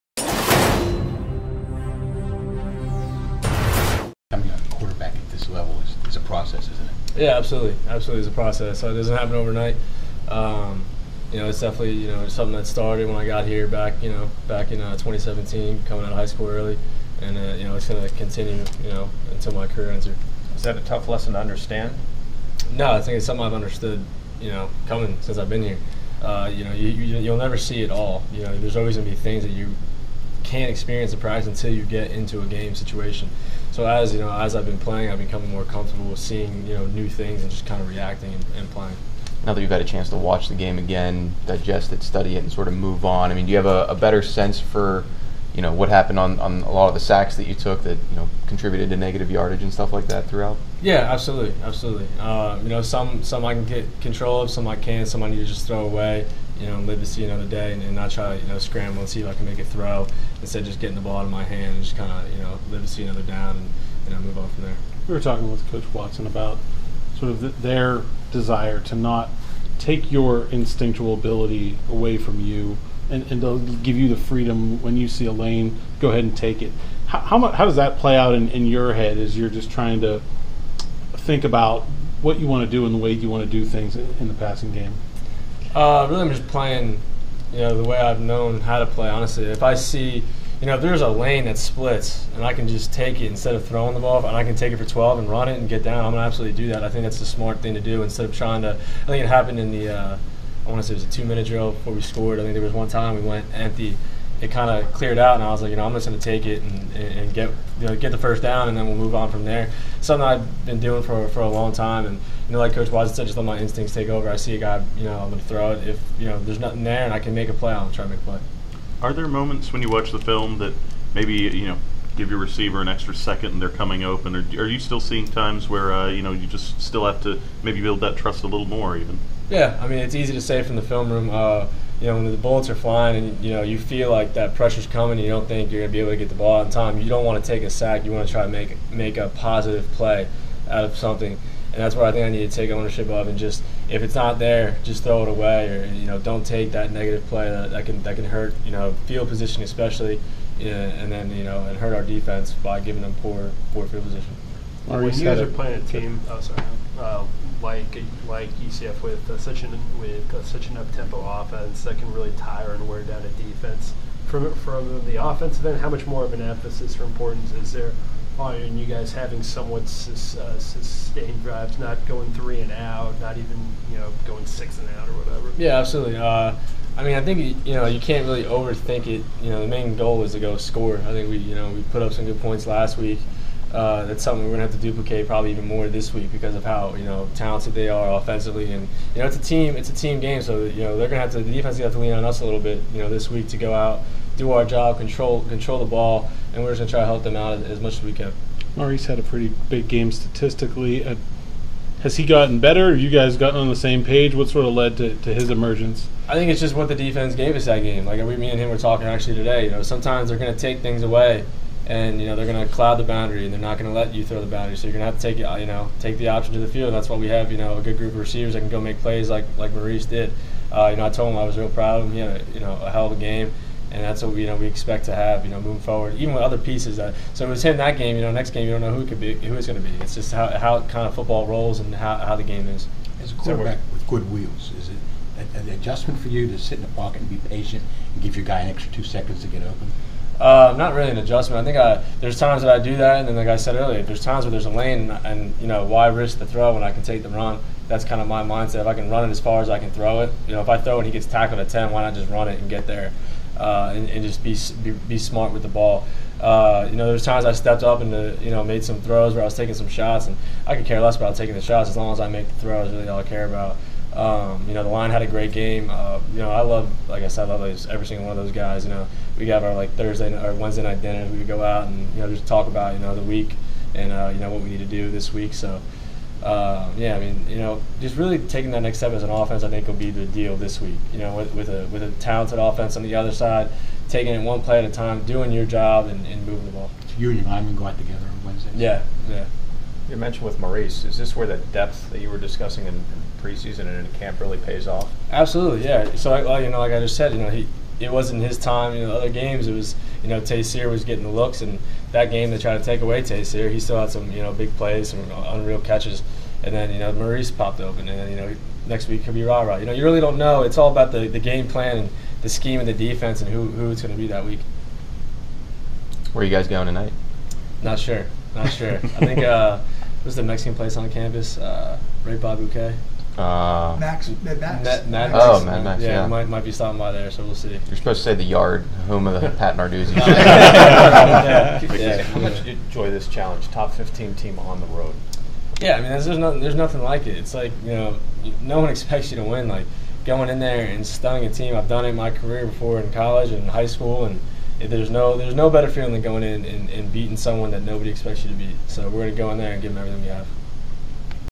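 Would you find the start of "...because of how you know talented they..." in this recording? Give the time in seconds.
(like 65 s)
186 s.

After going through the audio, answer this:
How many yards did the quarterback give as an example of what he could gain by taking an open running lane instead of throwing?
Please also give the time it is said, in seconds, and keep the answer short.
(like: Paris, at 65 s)
12, at 94 s.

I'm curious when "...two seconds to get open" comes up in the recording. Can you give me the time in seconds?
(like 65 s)
238 s.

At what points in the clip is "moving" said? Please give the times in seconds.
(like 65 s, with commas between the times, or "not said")
225 s, 286 s.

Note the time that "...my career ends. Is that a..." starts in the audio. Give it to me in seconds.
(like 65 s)
19 s.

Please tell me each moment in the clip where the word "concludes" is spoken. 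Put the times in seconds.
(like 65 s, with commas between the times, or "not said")
not said.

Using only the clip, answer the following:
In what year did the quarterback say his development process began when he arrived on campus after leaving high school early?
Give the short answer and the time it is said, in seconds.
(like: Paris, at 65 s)
2017, at 14 s.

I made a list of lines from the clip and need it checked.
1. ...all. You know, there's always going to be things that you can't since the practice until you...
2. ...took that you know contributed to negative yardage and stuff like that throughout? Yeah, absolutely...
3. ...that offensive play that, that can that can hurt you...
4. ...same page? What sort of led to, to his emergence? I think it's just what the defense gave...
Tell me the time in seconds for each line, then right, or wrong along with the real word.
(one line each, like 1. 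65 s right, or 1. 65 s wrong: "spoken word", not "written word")
1. 27 s wrong: "experience", not "since"
2. 47 s right
3. 146 s wrong: "negative", not "offensive"
4. 203 s right.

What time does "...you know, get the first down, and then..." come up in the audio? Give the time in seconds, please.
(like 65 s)
107 s.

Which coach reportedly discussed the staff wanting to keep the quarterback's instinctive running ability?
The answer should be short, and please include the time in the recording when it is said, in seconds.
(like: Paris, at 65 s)
Coach Watson, at 65 s.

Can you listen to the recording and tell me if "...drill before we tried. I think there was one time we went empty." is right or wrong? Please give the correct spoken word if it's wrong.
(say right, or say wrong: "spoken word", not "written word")
wrong: "scored", not "tried".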